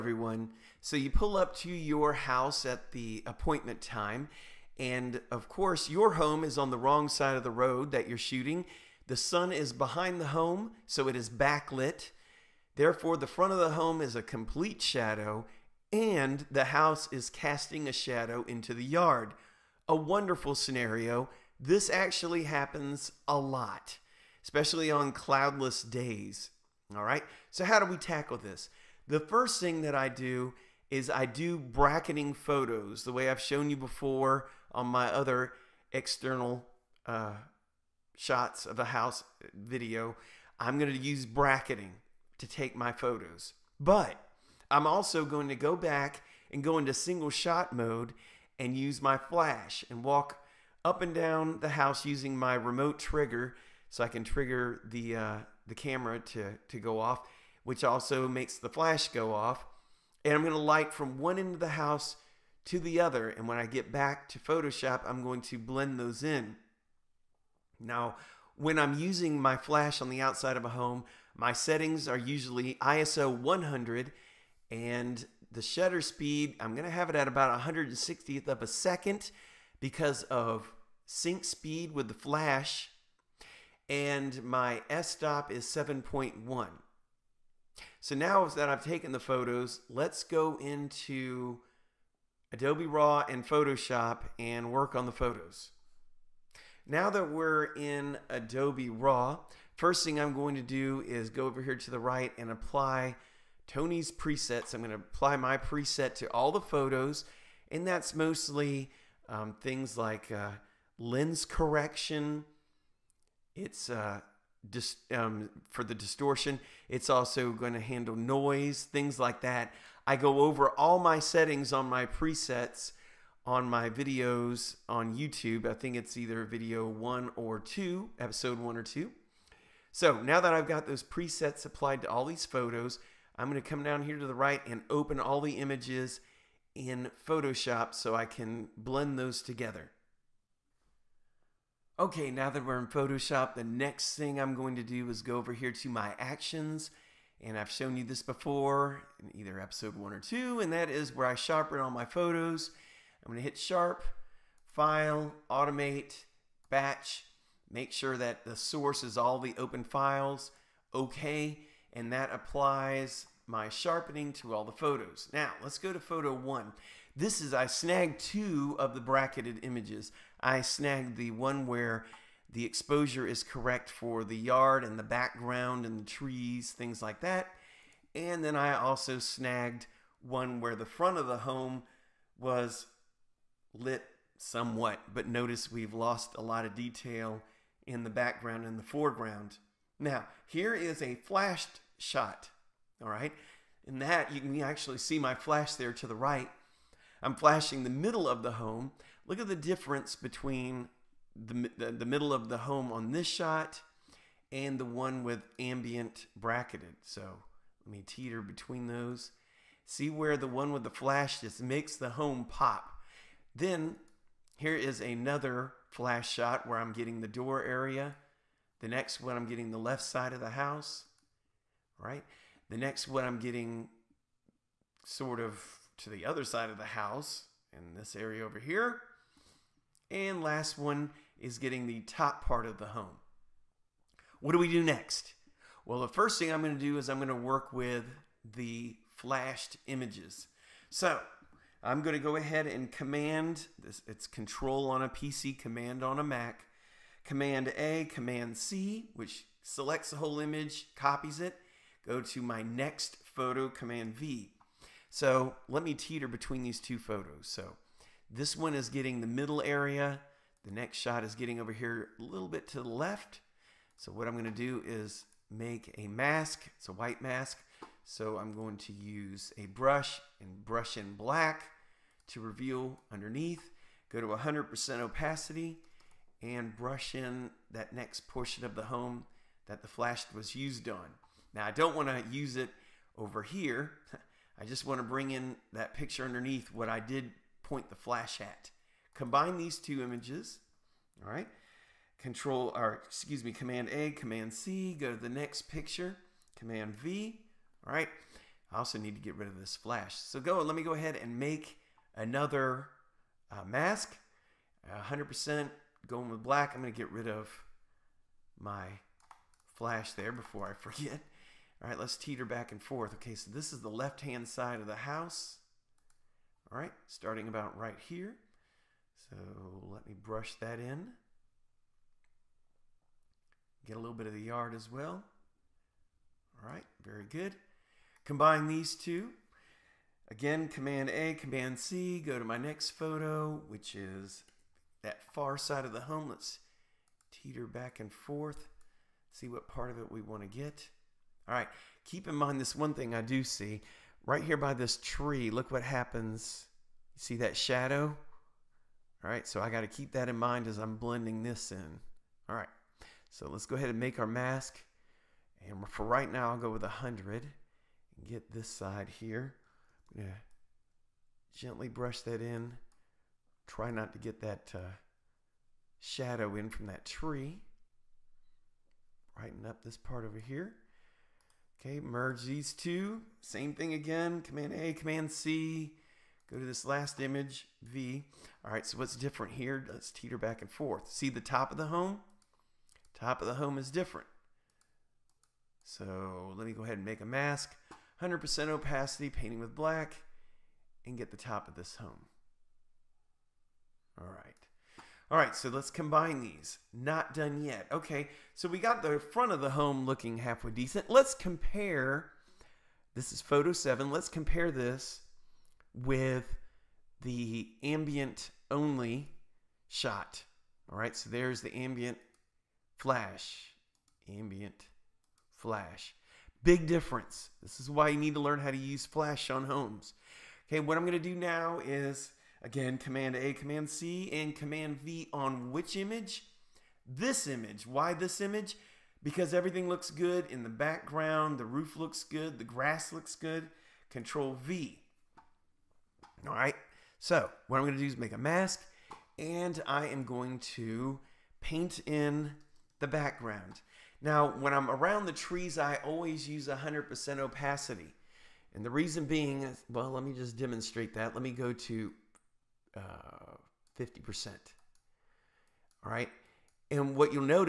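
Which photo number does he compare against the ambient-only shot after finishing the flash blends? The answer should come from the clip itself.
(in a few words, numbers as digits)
7.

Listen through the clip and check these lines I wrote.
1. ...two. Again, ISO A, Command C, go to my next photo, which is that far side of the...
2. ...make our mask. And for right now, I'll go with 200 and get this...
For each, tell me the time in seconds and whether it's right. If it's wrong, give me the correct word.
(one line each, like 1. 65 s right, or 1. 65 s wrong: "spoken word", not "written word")
1. 328 s wrong: "Command", not "ISO"
2. 353 s wrong: "100", not "200".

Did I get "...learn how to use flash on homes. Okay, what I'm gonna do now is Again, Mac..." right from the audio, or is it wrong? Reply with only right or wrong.
wrong.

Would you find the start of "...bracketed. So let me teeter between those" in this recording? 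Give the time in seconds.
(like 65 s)
206 s.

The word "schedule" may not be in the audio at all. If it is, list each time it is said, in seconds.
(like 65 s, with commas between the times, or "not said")
not said.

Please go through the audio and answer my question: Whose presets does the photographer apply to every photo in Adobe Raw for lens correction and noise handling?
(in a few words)
Tony's.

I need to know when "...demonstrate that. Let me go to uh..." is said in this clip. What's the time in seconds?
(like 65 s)
450 s.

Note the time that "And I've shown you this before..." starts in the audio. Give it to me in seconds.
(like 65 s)
147 s.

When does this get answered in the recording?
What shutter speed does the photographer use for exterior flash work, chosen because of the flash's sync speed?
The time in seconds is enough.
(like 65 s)
77 s.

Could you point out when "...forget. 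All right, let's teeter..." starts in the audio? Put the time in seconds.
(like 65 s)
310 s.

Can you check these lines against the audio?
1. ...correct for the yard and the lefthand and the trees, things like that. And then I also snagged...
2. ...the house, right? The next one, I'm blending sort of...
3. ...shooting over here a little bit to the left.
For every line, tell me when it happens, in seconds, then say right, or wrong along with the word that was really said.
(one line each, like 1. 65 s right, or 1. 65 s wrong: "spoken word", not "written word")
1. 173 s wrong: "background", not "lefthand"
2. 220 s wrong: "getting", not "blending"
3. 261 s wrong: "getting", not "shooting".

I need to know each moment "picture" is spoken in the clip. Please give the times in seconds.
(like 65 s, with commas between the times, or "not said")
285 s, 295 s.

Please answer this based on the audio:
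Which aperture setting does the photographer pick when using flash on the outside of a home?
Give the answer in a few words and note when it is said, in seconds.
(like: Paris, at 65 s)
f/7.1, at 85 s.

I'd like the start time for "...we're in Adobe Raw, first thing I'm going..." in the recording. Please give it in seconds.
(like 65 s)
97 s.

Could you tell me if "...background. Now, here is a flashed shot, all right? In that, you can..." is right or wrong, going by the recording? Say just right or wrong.
wrong.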